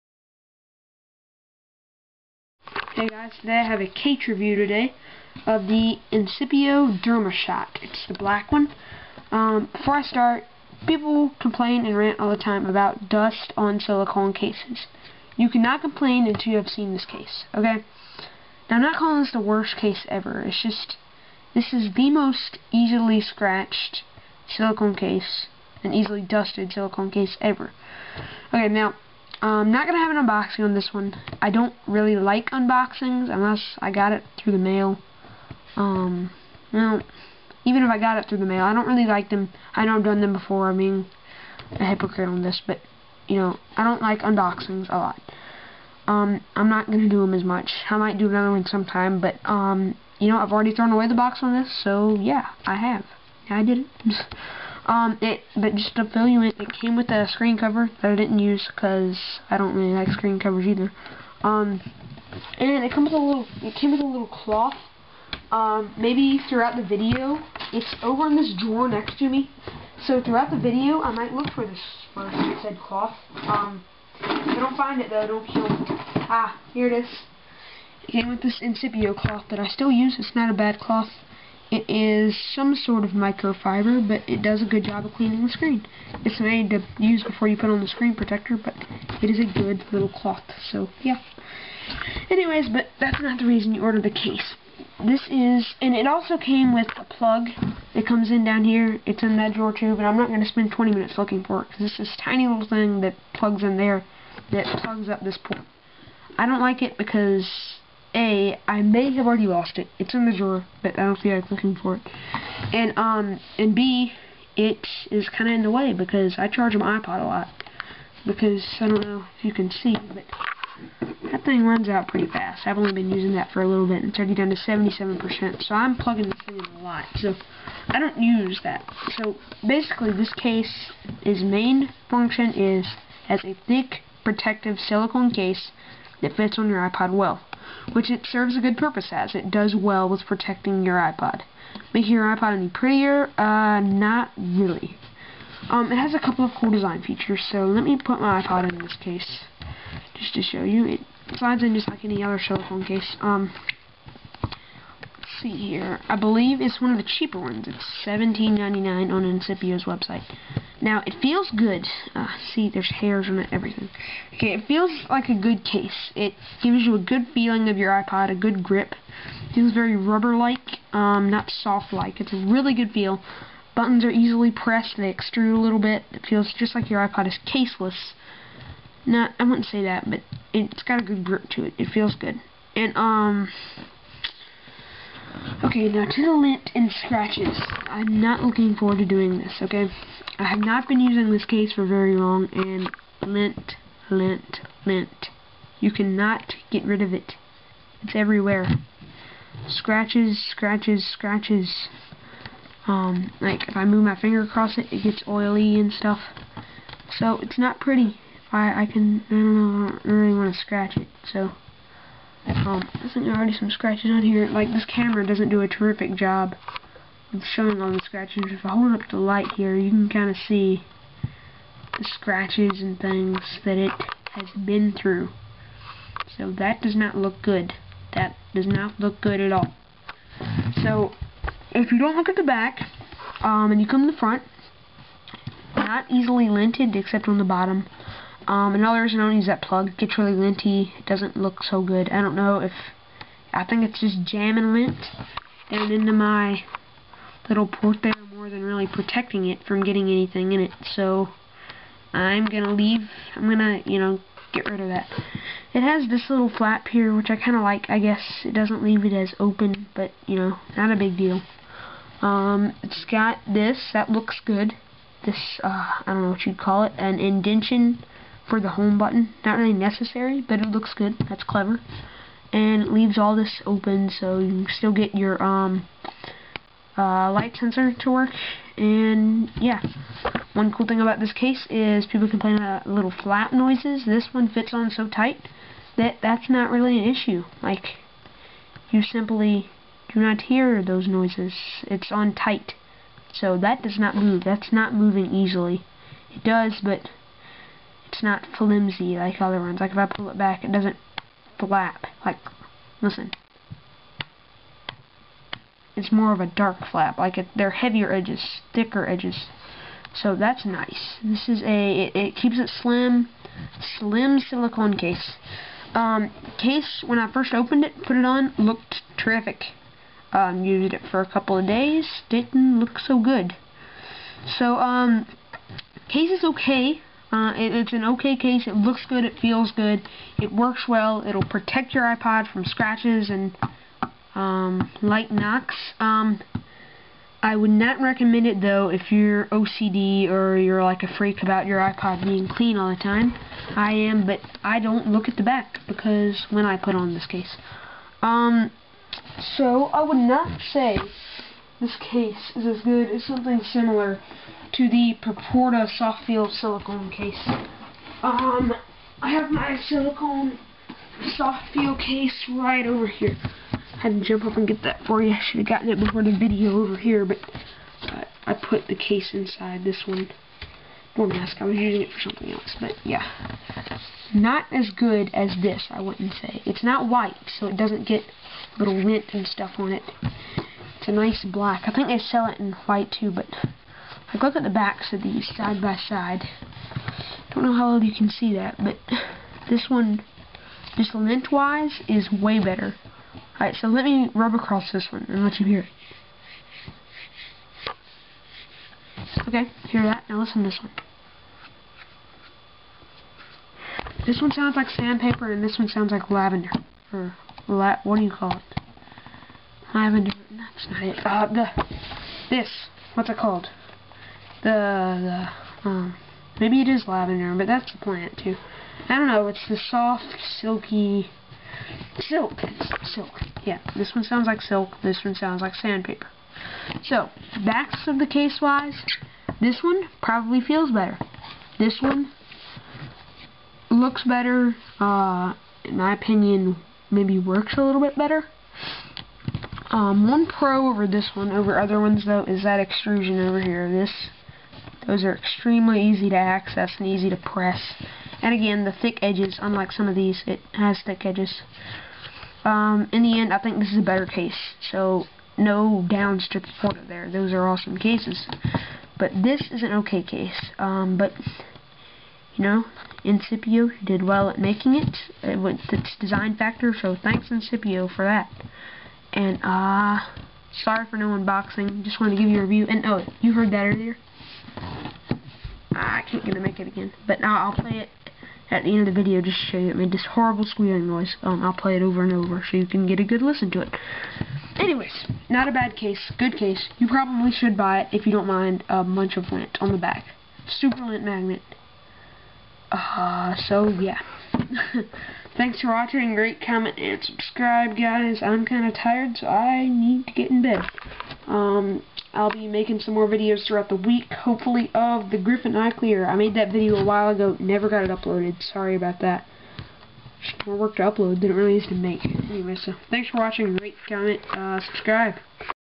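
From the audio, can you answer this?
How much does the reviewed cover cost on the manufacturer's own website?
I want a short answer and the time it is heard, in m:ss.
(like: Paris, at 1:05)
$17.99, at 2:38.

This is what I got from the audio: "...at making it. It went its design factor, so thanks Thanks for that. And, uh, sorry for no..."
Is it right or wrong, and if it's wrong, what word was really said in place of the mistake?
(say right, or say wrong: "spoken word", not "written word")
wrong: "Incipio", not "Thanks".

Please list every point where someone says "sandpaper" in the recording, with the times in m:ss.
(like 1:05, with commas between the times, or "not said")
6:44, 7:05.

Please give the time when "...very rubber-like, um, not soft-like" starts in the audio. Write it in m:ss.
2:49.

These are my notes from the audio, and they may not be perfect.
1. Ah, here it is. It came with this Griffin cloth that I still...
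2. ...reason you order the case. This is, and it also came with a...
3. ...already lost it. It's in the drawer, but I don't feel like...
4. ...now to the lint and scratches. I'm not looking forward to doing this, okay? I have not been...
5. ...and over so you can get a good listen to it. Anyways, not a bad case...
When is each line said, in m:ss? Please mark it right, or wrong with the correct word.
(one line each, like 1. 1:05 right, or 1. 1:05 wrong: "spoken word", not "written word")
1. 1:16 wrong: "Incipio", not "Griffin"
2. 1:33 right
3. 1:49 right
4. 3:05 right
5. 8:02 right.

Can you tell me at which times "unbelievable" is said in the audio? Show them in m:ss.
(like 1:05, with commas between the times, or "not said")
not said.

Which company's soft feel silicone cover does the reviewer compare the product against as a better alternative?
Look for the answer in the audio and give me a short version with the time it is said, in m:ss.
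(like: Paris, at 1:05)
Proporta, at 5:55.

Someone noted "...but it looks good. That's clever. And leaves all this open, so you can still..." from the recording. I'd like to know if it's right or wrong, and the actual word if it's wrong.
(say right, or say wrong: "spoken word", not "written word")
right.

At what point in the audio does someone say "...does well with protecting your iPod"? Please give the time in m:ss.
2:19.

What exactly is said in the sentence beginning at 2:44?
Okay, it feels like a good case.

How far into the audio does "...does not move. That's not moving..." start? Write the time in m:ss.
4:53.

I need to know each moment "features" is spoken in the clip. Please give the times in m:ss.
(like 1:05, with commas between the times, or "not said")
2:27.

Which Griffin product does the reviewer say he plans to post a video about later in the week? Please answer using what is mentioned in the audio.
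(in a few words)
Griffin iClear.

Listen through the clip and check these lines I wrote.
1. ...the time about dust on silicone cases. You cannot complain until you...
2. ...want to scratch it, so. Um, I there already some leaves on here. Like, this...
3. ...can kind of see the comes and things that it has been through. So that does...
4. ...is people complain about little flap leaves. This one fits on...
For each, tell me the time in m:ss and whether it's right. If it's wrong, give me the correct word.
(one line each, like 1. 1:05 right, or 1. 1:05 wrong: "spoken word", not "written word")
1. 0:12 right
2. 3:30 wrong: "scratches", not "leaves"
3. 3:39 wrong: "scratches", not "comes"
4. 4:41 wrong: "noises", not "leaves".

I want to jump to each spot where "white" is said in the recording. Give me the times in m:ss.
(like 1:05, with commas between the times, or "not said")
6:17, 6:22.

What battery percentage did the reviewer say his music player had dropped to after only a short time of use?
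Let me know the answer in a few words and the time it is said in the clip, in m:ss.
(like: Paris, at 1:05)
77%, at 2:04.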